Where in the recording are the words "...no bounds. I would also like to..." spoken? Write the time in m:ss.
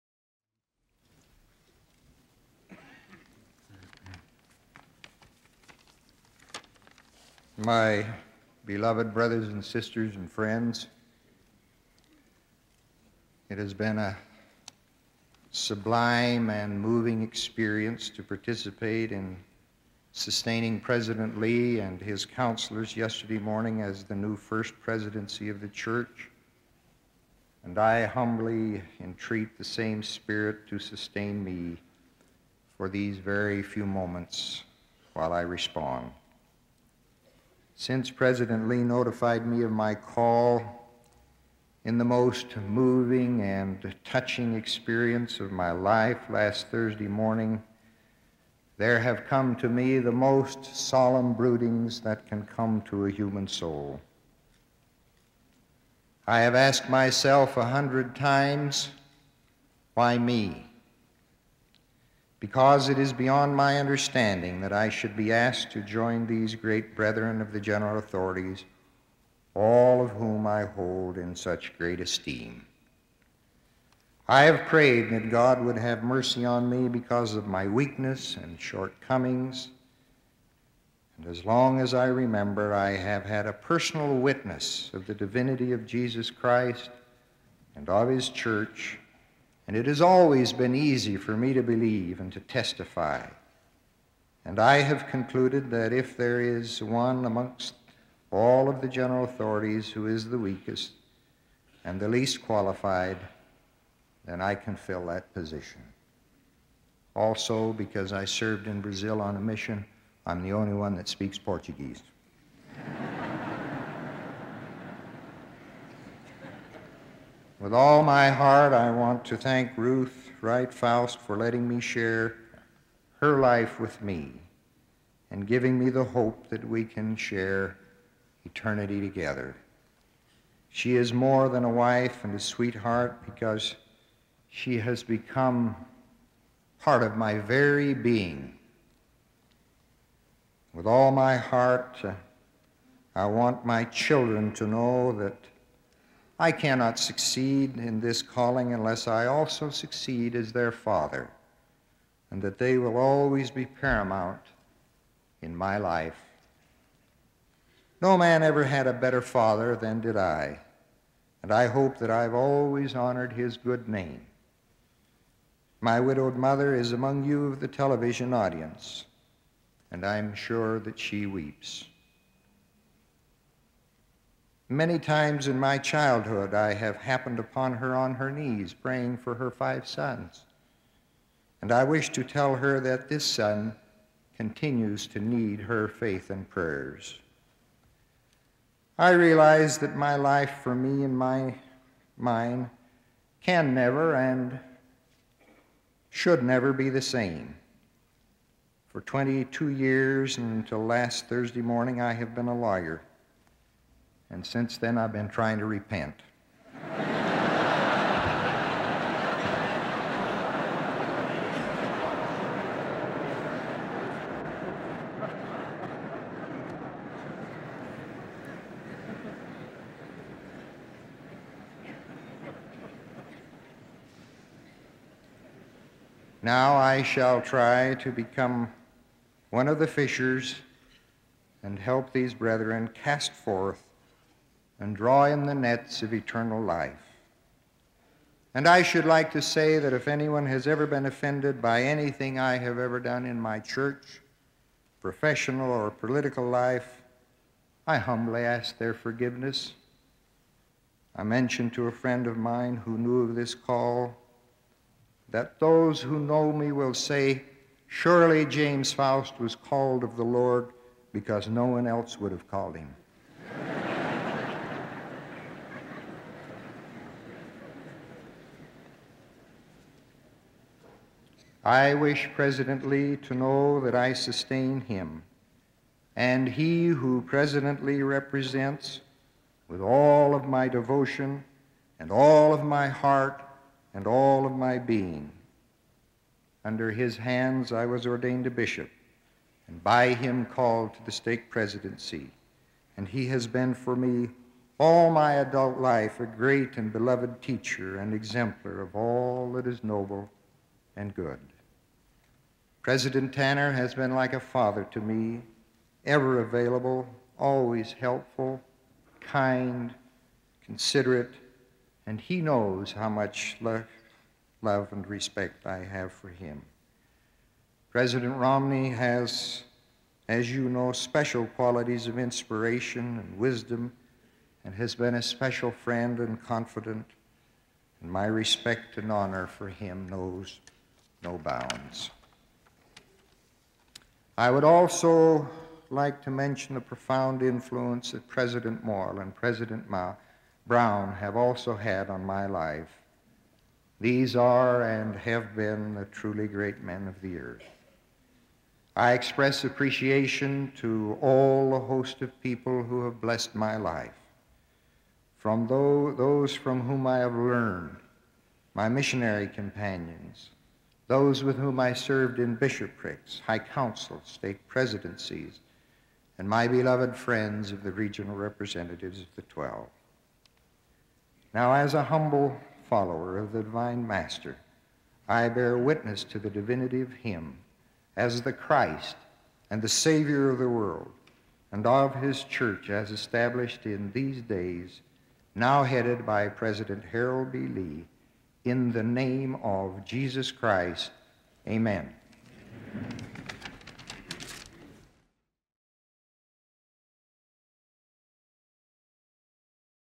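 5:31.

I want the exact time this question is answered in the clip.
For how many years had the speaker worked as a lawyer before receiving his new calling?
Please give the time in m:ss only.
3:19.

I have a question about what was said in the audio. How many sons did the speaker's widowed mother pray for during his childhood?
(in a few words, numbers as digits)
5.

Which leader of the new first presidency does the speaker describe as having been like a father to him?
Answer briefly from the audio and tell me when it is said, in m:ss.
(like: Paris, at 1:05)
President Tanner, at 5:02.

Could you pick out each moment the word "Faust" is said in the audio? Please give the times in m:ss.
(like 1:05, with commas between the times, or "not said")
2:00, 4:18.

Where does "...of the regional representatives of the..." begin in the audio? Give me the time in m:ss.
6:07.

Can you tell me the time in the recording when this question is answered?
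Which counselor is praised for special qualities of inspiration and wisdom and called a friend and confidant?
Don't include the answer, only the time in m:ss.
5:17.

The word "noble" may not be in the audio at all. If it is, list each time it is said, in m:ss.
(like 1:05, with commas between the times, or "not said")
4:59.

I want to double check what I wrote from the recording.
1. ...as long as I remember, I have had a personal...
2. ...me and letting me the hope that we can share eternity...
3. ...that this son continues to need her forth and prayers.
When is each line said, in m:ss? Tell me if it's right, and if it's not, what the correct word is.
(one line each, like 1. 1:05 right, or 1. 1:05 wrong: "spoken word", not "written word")
1. 1:21 right
2. 2:04 wrong: "giving", not "letting"
3. 3:02 wrong: "faith", not "forth".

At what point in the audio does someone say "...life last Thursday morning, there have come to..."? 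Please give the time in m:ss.
0:45.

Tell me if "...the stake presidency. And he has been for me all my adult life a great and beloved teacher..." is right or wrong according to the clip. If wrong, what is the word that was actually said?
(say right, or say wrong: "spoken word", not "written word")
right.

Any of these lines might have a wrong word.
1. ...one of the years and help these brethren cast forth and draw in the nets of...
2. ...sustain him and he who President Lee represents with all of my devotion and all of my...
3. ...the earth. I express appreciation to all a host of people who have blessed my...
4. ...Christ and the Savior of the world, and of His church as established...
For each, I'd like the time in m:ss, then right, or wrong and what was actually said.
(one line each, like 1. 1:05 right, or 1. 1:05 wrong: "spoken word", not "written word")
1. 3:49 wrong: "fishers", not "years"
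2. 4:34 right
3. 5:47 right
4. 6:18 right.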